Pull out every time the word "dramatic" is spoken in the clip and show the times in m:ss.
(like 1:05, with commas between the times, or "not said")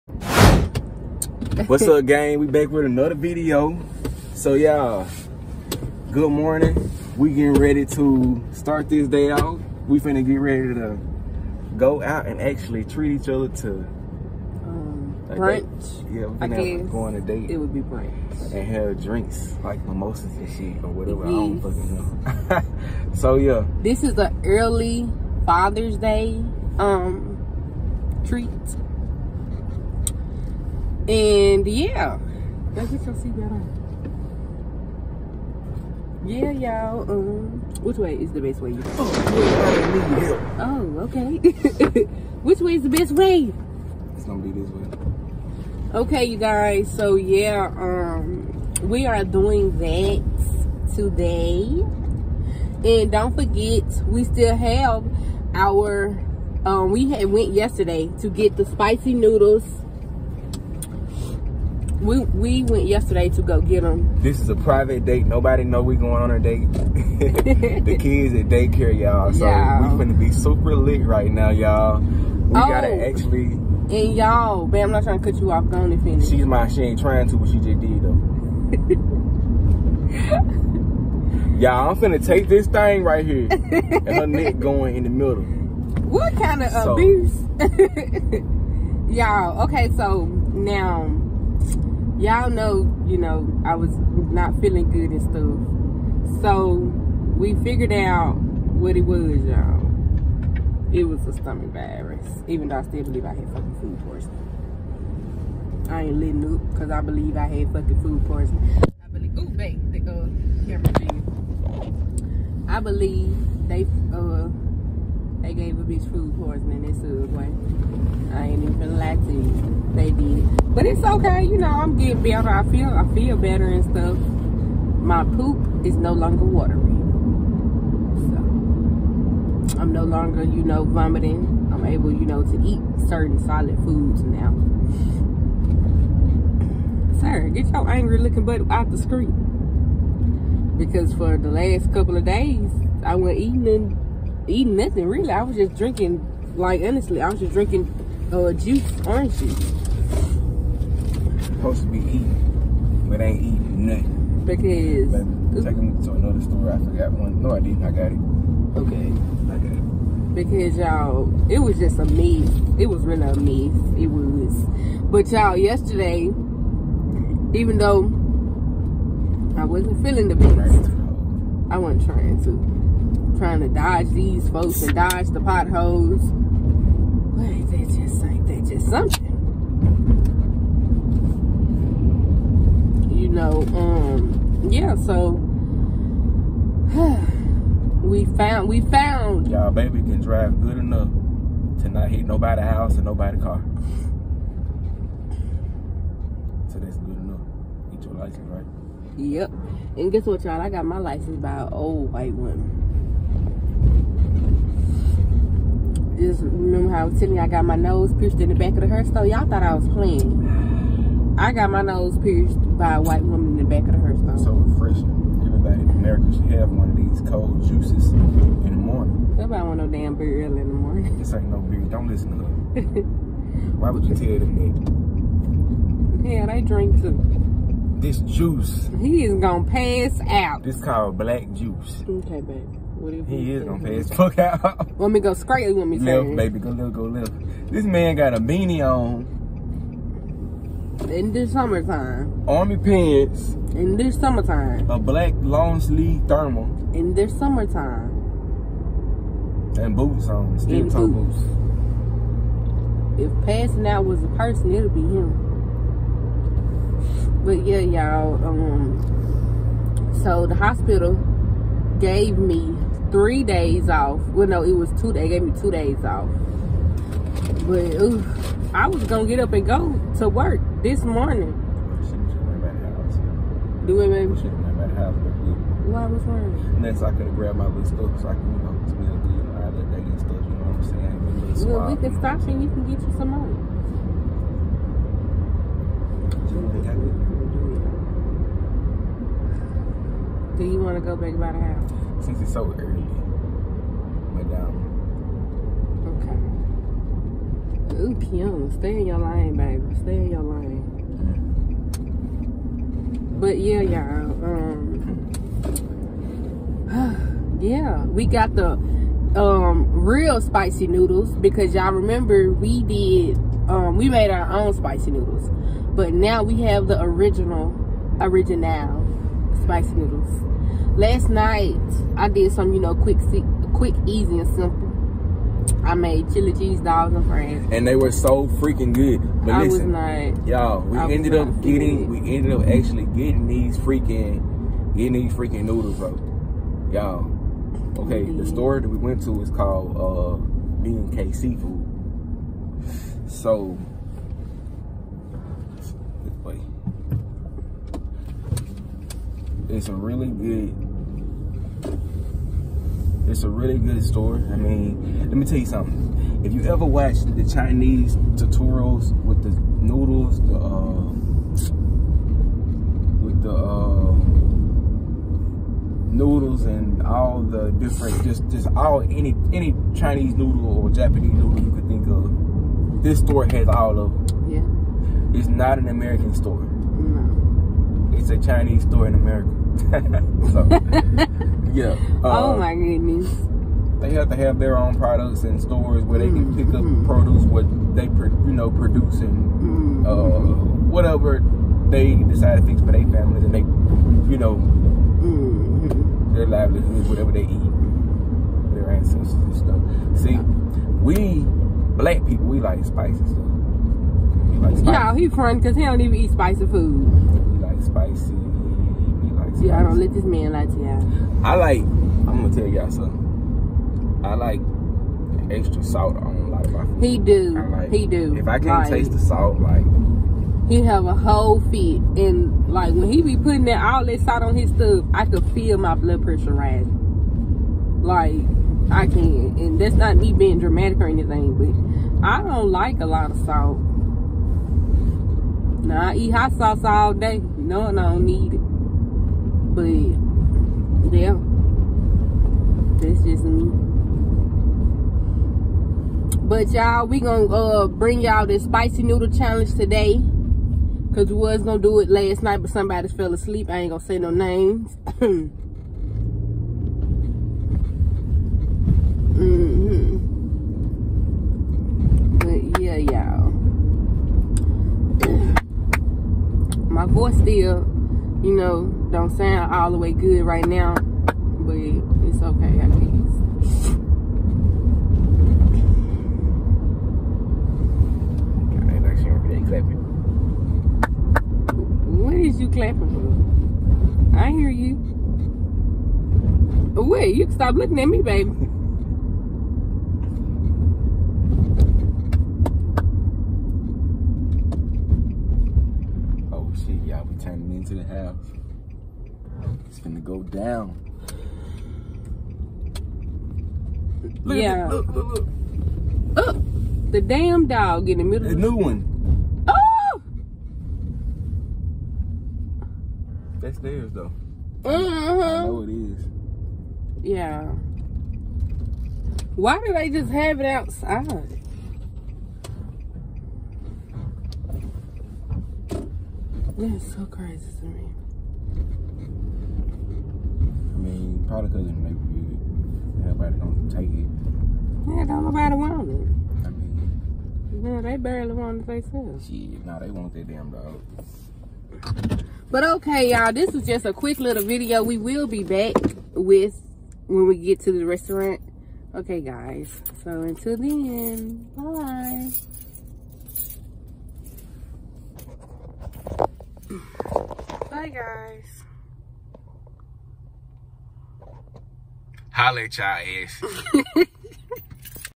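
7:10.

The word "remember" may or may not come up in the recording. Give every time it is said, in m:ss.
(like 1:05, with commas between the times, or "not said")
3:26, 5:11.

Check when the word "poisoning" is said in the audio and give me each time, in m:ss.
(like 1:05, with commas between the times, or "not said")
1:44, 1:48, 1:56.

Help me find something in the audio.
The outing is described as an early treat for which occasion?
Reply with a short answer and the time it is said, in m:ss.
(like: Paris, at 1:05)
Father's Day, at 0:25.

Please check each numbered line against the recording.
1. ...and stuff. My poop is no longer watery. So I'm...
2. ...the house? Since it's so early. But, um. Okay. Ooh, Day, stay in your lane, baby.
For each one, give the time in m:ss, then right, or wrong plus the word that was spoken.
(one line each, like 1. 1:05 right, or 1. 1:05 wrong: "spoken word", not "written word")
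1. 2:03 right
2. 4:51 wrong: "Kim", not "Day".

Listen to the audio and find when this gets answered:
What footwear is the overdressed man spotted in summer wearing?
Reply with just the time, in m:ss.
4:10.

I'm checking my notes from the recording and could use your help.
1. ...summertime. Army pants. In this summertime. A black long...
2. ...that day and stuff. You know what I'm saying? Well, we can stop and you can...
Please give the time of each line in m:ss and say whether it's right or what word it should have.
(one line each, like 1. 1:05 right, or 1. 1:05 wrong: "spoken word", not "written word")
1. 4:01 right
2. 4:39 right.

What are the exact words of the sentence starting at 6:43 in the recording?
We like Y'all, he fun because he don't even eat spicy food.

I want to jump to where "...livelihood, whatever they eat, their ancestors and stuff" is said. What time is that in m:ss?
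6:36.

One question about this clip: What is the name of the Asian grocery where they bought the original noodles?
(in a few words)
B&K Seafood.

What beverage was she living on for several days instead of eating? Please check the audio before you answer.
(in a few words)
Orange juice.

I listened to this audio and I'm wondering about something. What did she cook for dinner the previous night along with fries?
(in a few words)
Chili cheese dogs.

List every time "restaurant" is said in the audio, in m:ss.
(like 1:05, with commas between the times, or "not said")
9:08.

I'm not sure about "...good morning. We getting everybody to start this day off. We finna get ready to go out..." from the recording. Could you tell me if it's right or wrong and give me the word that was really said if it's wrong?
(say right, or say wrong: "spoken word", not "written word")
wrong: "ready", not "everybody".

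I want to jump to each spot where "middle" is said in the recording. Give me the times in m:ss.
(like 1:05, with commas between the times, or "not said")
1:25, 8:28.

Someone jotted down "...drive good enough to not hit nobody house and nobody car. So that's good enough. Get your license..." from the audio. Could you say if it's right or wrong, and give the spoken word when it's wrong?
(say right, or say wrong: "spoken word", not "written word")
right.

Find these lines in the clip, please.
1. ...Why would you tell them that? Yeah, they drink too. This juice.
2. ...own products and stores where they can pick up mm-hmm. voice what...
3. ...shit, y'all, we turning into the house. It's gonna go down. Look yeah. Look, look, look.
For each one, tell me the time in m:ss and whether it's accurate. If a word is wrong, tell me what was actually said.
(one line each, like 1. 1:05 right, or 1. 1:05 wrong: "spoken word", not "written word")
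1. 3:43 right
2. 6:24 wrong: "produce", not "voice"
3. 8:16 right.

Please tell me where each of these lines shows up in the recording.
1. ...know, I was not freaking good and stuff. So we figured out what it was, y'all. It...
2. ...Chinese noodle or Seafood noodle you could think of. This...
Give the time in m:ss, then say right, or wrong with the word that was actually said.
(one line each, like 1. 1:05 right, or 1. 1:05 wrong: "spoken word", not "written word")
1. 1:33 wrong: "feeling", not "freaking"
2. 6:09 wrong: "Japanese", not "Seafood".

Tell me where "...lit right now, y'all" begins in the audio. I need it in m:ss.
1:10.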